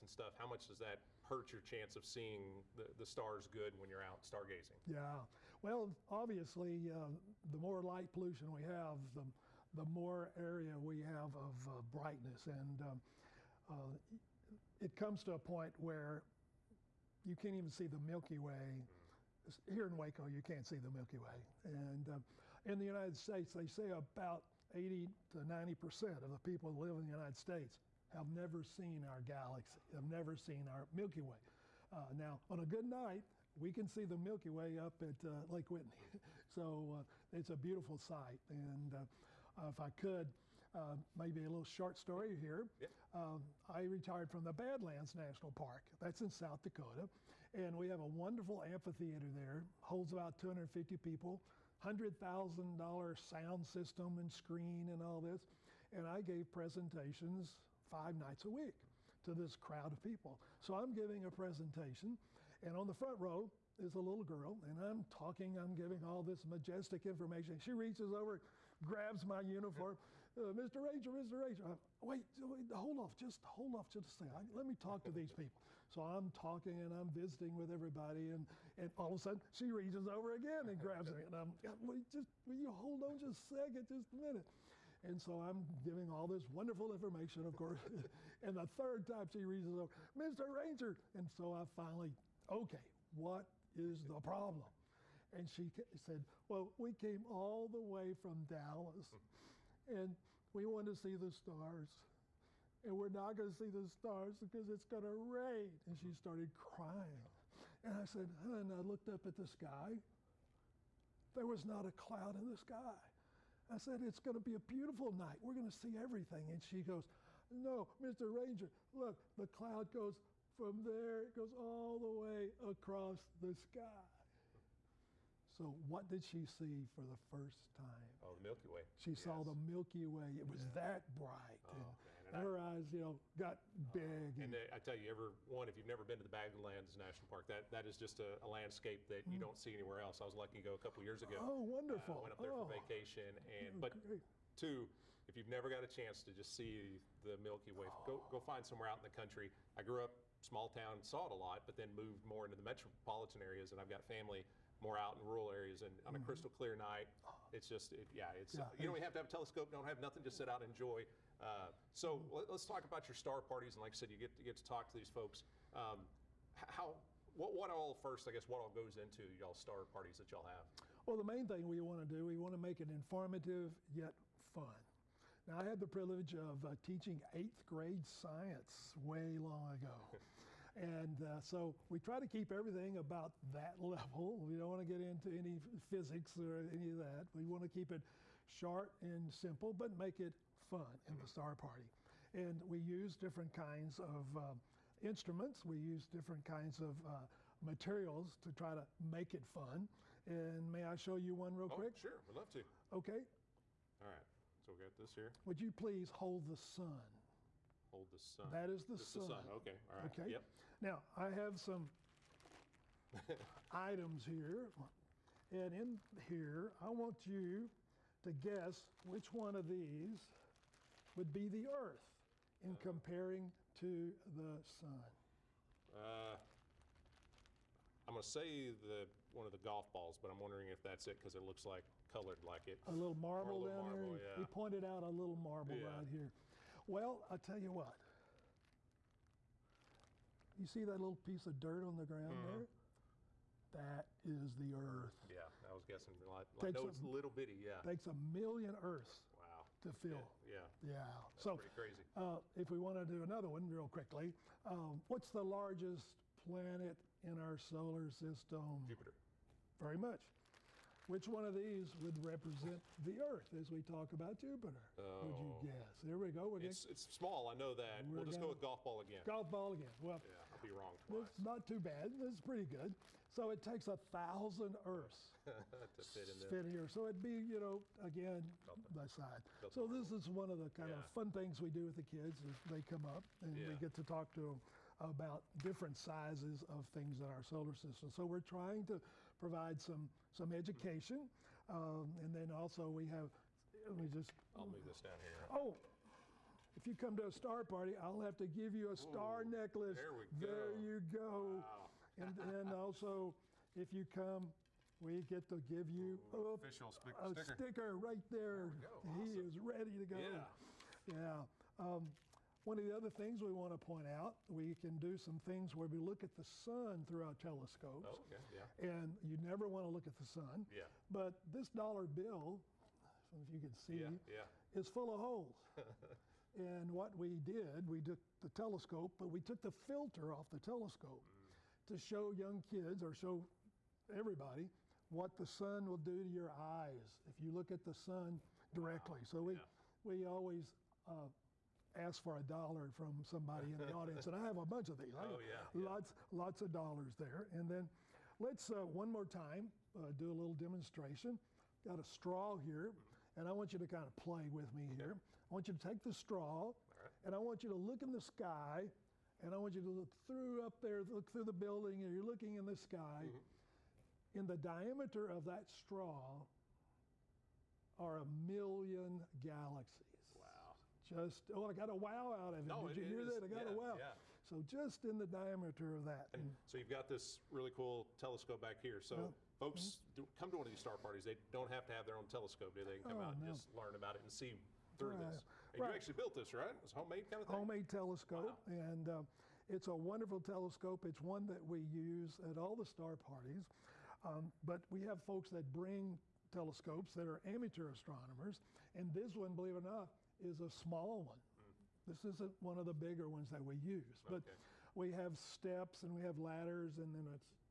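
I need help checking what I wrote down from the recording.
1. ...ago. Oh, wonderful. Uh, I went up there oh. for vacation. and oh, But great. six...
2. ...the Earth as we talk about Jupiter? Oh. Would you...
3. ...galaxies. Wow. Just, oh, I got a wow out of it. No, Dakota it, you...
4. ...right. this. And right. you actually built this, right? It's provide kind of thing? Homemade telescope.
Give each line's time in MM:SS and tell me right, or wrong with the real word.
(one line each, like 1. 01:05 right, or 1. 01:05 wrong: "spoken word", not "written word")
1. 02:21 wrong: "two", not "six"
2. 04:22 right
3. 06:09 wrong: "Did", not "Dakota"
4. 06:25 wrong: "homemade", not "provide".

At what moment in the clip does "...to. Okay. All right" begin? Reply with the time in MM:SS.
03:22.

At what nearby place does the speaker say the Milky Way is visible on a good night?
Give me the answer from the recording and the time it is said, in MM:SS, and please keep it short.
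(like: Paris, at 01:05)
Lake Whitney, at 00:35.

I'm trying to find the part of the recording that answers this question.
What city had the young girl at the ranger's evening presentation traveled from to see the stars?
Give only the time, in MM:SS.
01:38.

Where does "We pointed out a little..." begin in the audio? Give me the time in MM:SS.
03:54.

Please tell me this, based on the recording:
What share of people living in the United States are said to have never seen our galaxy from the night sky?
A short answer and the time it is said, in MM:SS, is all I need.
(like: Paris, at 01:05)
80 to 90%, at 00:24.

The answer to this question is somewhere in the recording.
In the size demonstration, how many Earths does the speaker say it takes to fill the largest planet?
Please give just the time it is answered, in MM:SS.
04:33.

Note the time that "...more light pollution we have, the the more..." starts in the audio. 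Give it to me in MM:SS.
00:07.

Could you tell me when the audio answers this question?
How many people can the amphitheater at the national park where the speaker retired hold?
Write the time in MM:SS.
00:50.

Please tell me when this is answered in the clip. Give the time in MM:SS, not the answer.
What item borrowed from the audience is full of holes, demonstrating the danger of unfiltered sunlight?
05:21.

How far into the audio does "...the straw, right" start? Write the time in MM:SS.
05:56.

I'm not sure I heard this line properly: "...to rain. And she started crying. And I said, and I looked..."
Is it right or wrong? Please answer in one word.
right.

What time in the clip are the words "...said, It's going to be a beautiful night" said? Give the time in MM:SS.
01:53.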